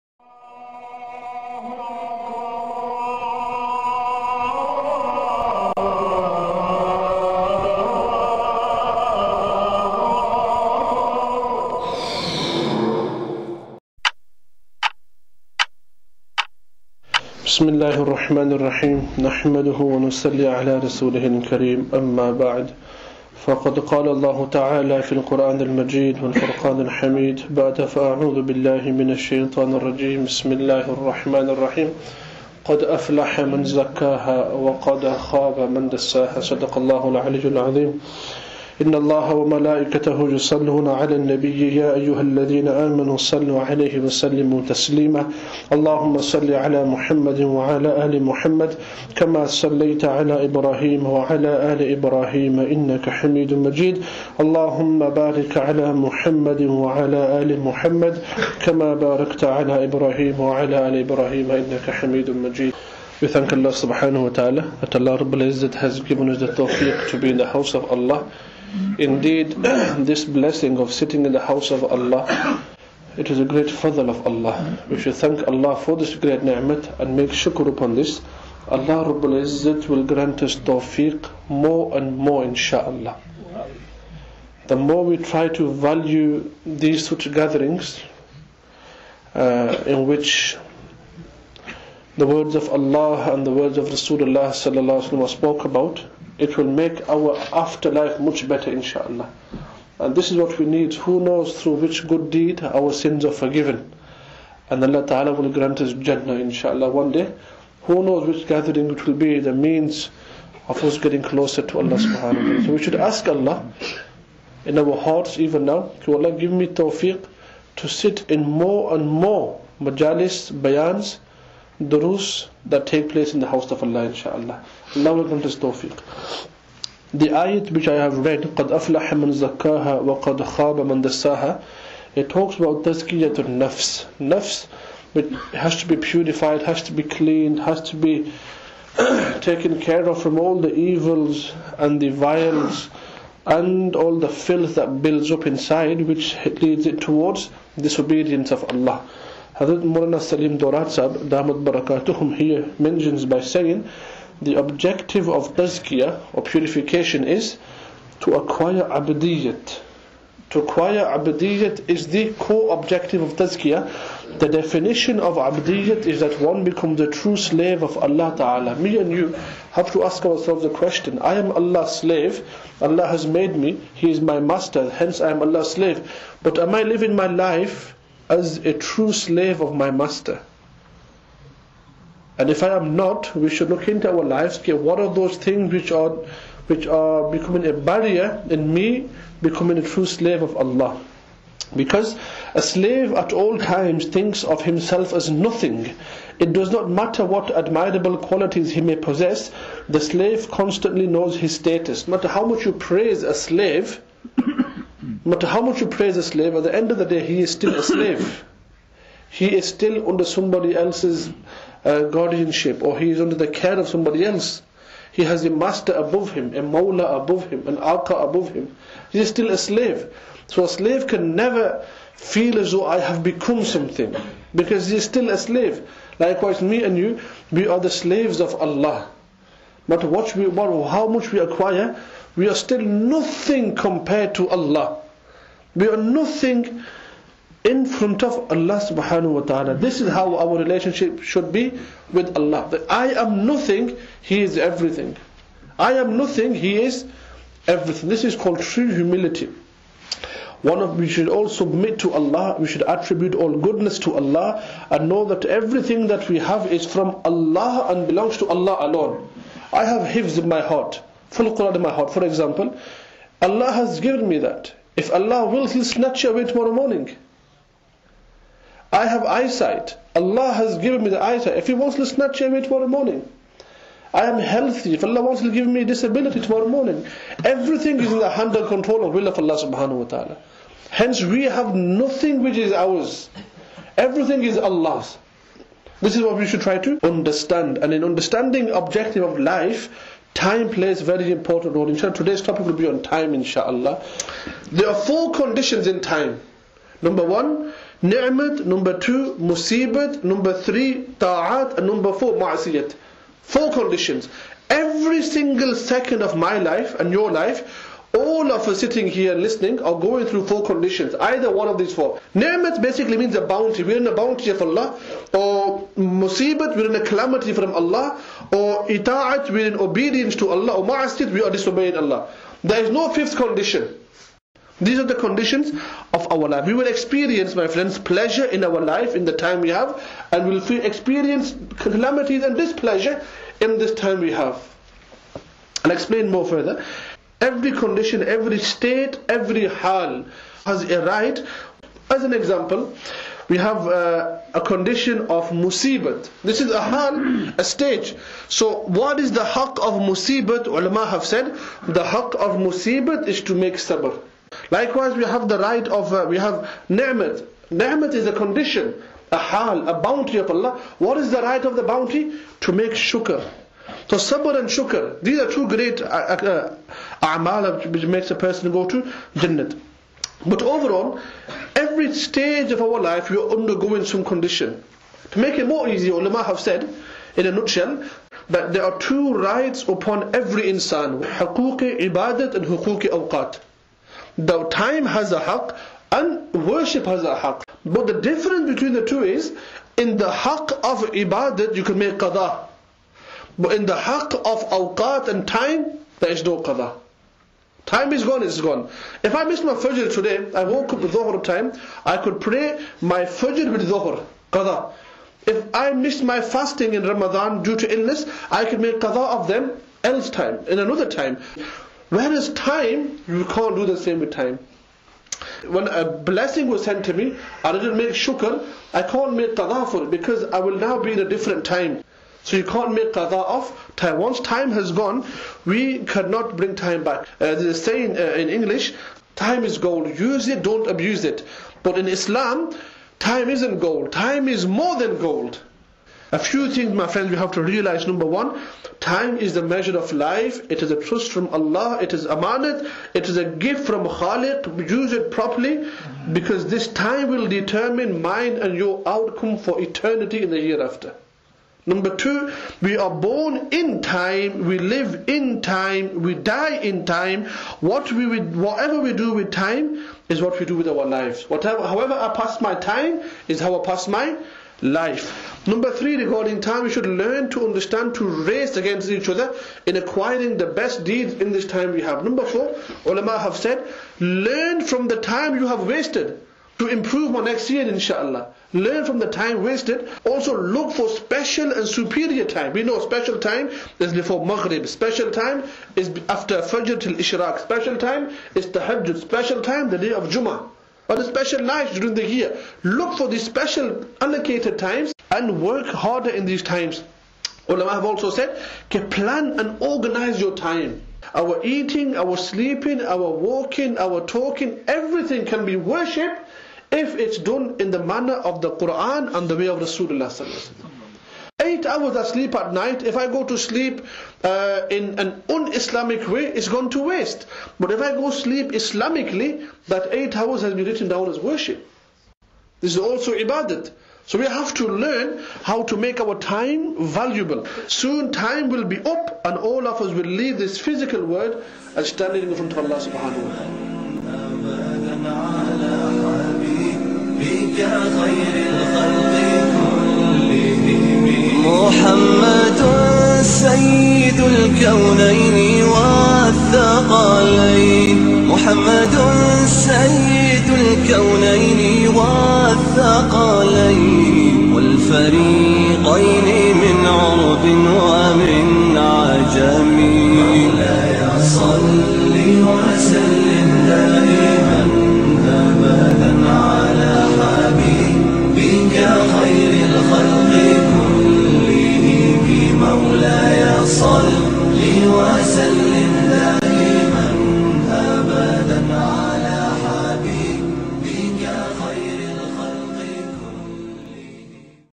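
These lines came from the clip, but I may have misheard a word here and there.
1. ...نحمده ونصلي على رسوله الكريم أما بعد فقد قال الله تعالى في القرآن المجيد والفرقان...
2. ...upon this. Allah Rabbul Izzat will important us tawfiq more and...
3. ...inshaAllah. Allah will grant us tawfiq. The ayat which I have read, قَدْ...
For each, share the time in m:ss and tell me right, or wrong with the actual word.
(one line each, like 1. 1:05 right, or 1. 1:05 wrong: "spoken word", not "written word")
1. 0:19 right
2. 1:17 wrong: "grant", not "important"
3. 2:04 right.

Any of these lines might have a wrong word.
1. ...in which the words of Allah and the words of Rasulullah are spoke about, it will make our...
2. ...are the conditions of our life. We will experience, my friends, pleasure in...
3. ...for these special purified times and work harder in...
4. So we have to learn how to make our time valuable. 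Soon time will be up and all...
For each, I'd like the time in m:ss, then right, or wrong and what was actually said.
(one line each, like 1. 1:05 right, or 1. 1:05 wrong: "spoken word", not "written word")
1. 1:29 right
2. 5:24 right
3. 8:13 wrong: "allocated", not "purified"
4. 8:44 right.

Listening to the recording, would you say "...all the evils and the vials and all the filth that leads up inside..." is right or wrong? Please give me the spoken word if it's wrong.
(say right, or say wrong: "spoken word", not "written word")
wrong: "builds", not "leads".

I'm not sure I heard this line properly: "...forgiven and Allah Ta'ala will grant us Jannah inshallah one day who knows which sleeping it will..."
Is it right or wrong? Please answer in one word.
wrong.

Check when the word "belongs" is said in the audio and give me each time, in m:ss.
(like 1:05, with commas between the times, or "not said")
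4:18.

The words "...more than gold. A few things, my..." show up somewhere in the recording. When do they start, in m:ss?
7:14.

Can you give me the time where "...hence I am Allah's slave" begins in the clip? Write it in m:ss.
2:54.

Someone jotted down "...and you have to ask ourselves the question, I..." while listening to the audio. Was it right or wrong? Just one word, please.
right.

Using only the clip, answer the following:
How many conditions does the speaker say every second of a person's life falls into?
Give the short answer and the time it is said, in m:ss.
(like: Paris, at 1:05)
4, at 4:54.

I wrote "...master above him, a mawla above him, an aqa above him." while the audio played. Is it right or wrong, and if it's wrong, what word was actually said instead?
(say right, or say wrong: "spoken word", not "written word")
right.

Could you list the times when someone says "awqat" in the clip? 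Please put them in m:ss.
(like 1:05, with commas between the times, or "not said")
6:23, 6:34.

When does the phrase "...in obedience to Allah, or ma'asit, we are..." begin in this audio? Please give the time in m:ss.
5:19.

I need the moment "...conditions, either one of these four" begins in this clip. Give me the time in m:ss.
5:10.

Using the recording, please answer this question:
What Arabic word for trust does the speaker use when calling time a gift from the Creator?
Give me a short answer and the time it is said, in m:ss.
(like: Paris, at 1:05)
amanat, at 7:22.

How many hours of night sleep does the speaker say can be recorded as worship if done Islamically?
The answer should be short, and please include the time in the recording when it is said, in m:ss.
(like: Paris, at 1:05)
8, at 8:31.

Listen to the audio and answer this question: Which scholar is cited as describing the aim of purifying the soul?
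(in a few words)
Maulana Salim Dhorat Sahib.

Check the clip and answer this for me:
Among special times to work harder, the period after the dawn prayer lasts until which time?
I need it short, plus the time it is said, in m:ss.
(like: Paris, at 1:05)
Ishraq, at 8:06.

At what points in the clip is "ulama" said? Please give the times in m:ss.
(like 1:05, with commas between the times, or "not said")
5:50, 6:16, 7:53, 8:17.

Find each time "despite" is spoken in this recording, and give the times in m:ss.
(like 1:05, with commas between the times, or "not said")
not said.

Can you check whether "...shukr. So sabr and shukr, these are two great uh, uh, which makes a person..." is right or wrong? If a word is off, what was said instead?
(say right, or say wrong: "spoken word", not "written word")
right.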